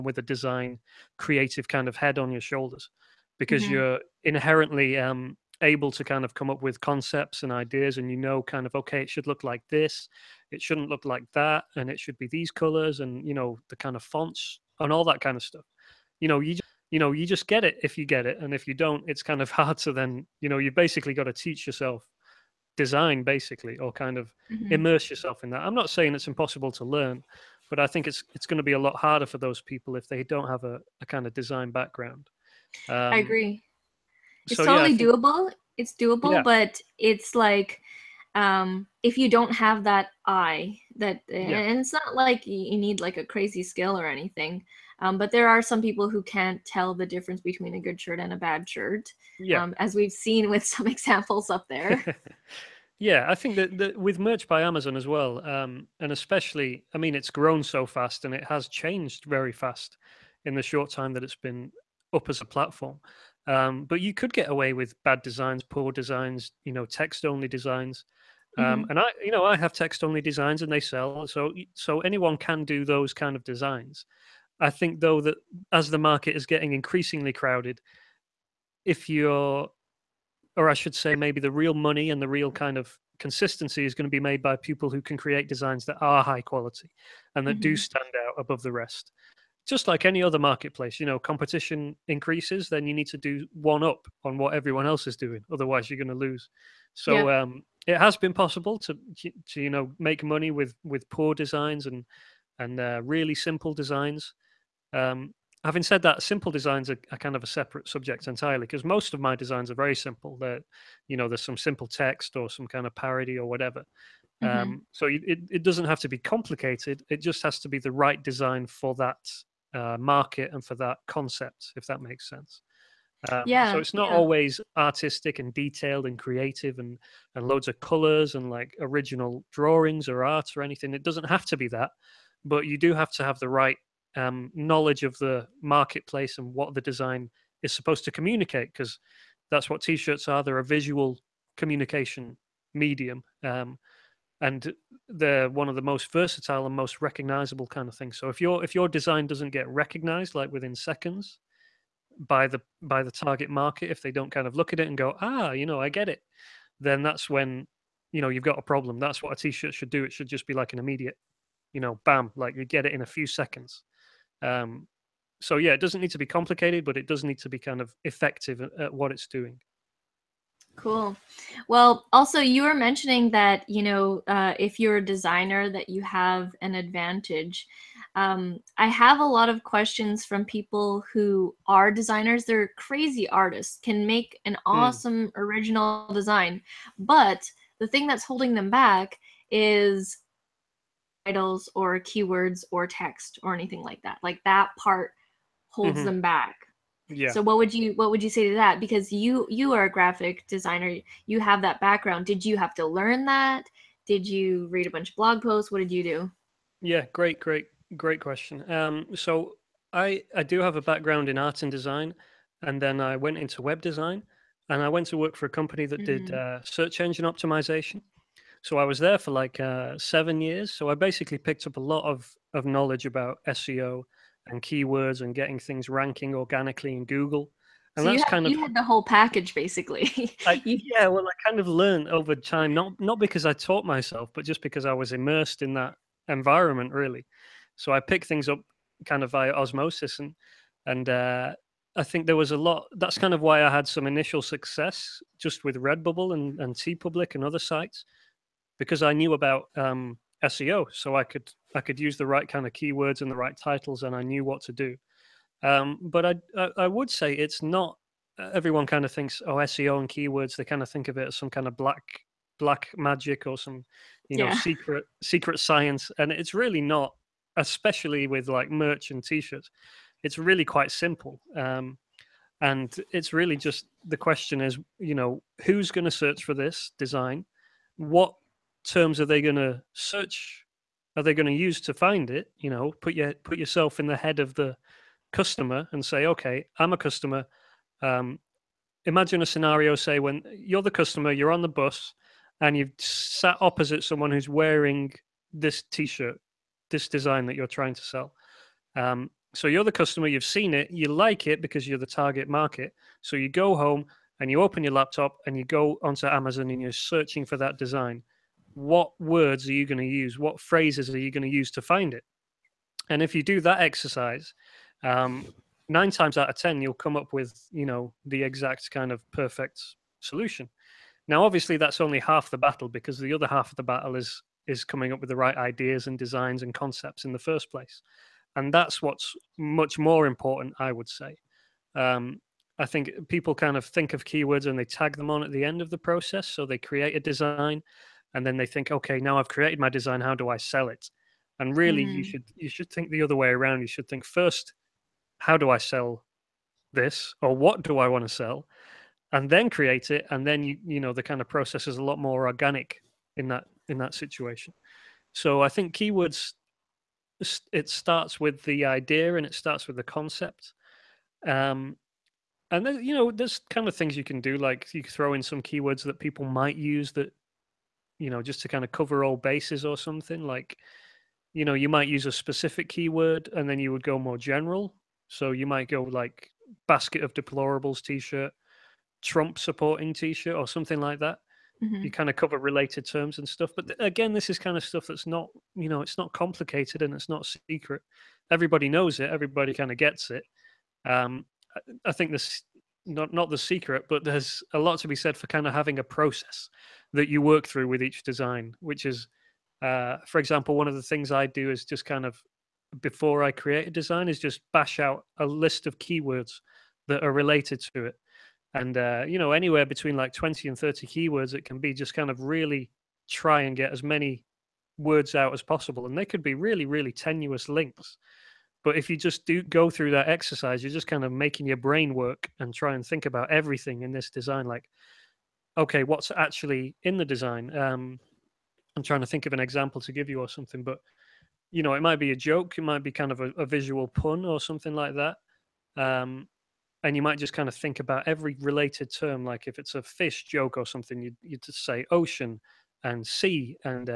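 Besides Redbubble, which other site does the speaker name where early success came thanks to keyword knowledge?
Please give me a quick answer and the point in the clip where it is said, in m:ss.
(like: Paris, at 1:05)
Public, at 4:06.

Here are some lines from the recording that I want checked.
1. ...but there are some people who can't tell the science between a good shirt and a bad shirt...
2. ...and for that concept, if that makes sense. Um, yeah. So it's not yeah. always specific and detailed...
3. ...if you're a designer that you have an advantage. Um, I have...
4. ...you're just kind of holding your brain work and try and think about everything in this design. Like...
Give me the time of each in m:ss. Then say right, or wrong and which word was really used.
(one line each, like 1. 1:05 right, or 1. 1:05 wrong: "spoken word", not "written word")
1. 0:45 wrong: "difference", not "science"
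2. 2:00 wrong: "artistic", not "specific"
3. 2:54 right
4. 7:00 wrong: "making", not "holding".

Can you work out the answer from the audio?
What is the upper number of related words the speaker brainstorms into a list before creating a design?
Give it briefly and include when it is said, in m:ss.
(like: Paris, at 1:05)
30, at 6:50.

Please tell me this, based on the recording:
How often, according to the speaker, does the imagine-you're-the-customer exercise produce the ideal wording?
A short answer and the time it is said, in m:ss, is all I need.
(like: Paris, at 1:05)
9 times out of 10, at 5:15.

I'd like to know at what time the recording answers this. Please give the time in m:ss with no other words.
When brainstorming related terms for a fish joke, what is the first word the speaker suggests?
7:22.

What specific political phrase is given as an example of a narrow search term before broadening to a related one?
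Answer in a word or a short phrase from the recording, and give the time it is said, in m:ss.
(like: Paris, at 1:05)
Basket of deplorables, at 6:16.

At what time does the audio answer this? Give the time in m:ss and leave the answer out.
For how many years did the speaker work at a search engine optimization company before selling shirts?
3:39.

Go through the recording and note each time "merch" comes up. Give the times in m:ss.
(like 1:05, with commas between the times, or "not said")
0:54, 4:28.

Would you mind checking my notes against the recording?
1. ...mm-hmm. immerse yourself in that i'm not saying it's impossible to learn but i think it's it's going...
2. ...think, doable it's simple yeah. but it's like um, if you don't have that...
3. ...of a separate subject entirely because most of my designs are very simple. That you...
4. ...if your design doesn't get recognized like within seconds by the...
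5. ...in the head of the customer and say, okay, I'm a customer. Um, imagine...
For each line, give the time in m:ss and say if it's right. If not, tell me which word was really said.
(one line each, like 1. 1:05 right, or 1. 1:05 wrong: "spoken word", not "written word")
1. 0:24 right
2. 0:34 wrong: "doable", not "simple"
3. 1:47 right
4. 2:28 right
5. 4:43 right.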